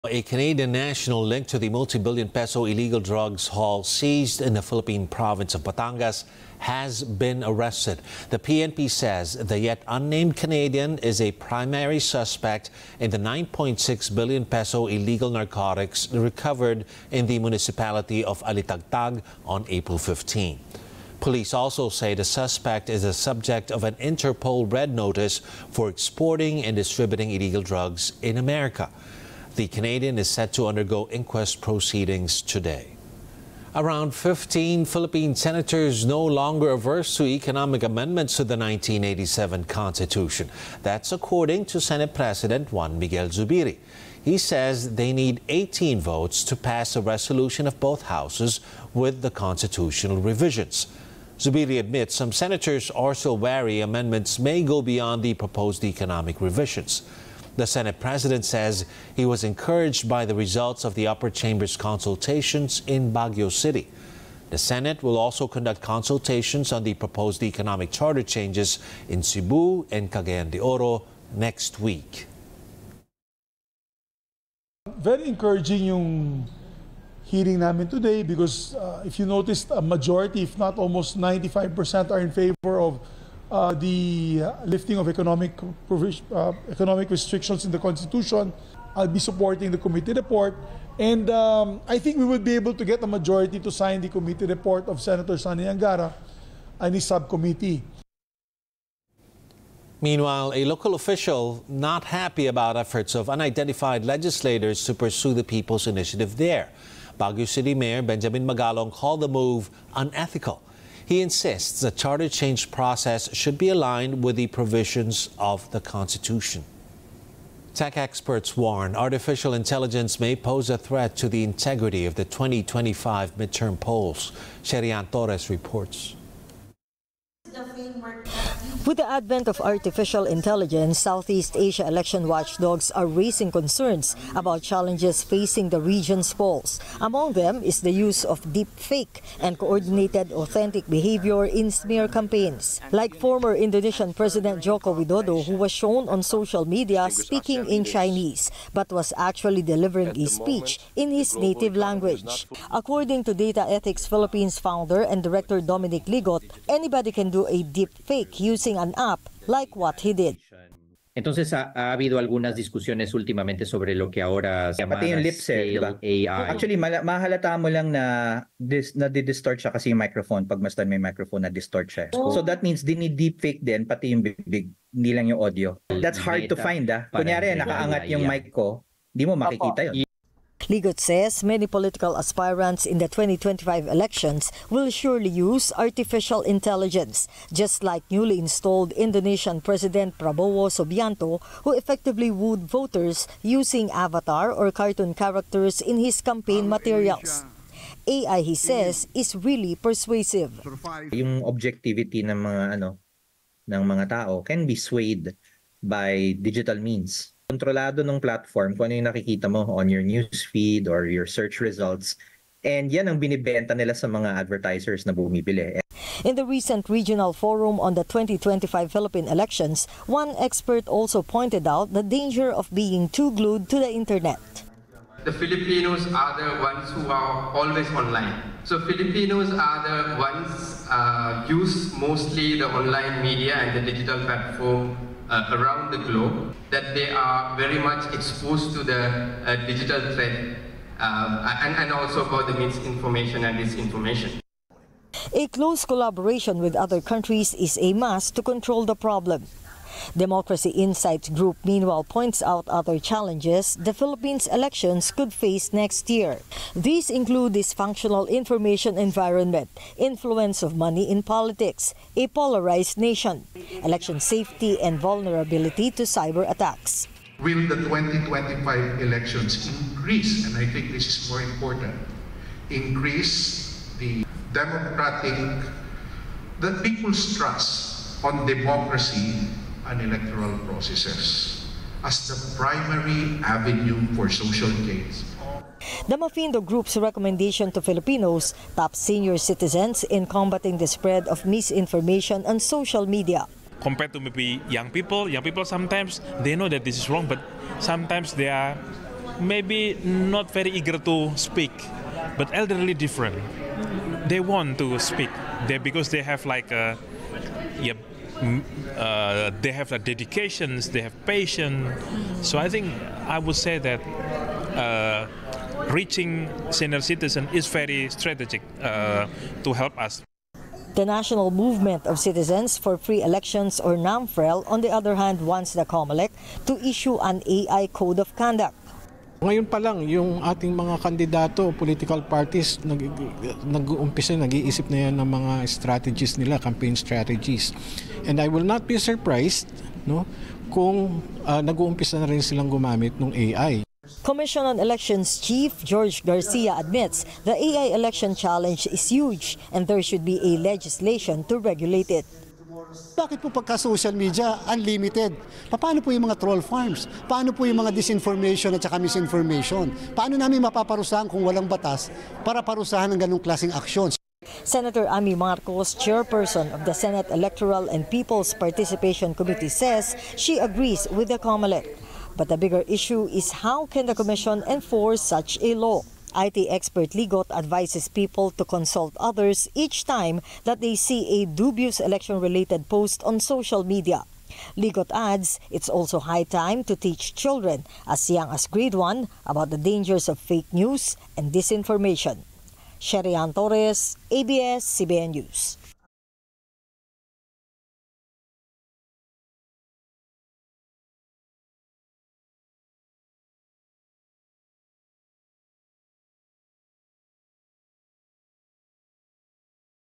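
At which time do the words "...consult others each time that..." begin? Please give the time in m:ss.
6:18.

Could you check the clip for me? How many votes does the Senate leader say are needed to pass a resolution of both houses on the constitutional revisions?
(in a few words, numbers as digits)
18.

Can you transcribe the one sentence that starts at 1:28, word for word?
I'll be supporting the committee report.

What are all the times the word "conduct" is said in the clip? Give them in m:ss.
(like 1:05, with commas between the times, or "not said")
1:05, 5:28.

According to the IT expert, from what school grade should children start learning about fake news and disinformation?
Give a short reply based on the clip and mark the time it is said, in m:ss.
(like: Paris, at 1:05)
grade 1, at 6:28.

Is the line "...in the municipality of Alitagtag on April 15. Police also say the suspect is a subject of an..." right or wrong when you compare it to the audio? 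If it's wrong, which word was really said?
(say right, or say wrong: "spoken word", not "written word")
right.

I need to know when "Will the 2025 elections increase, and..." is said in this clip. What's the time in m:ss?
4:27.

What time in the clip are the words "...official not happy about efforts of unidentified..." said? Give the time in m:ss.
1:40.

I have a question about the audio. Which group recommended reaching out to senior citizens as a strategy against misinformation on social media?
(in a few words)
Mafindo Group.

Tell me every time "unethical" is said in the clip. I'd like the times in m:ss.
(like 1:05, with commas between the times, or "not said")
1:49.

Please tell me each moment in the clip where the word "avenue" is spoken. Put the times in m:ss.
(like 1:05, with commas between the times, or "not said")
4:43.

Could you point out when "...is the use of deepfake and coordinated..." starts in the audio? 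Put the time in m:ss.
2:17.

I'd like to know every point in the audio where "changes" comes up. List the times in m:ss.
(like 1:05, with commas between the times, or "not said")
1:08, 1:52.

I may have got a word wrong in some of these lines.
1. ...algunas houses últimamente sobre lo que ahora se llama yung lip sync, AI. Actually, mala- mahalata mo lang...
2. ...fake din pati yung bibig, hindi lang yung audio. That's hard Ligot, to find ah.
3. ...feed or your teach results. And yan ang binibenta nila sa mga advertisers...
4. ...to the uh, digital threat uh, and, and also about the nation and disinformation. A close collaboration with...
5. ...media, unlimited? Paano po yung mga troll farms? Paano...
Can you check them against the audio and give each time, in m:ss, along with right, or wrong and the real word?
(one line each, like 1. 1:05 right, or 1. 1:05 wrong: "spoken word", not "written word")
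1. 2:42 wrong: "discusiones", not "houses"
2. 2:53 wrong: "Meta", not "Ligot"
3. 3:30 wrong: "search", not "teach"
4. 3:58 wrong: "misinformation", not "nation"
5. 5:54 right.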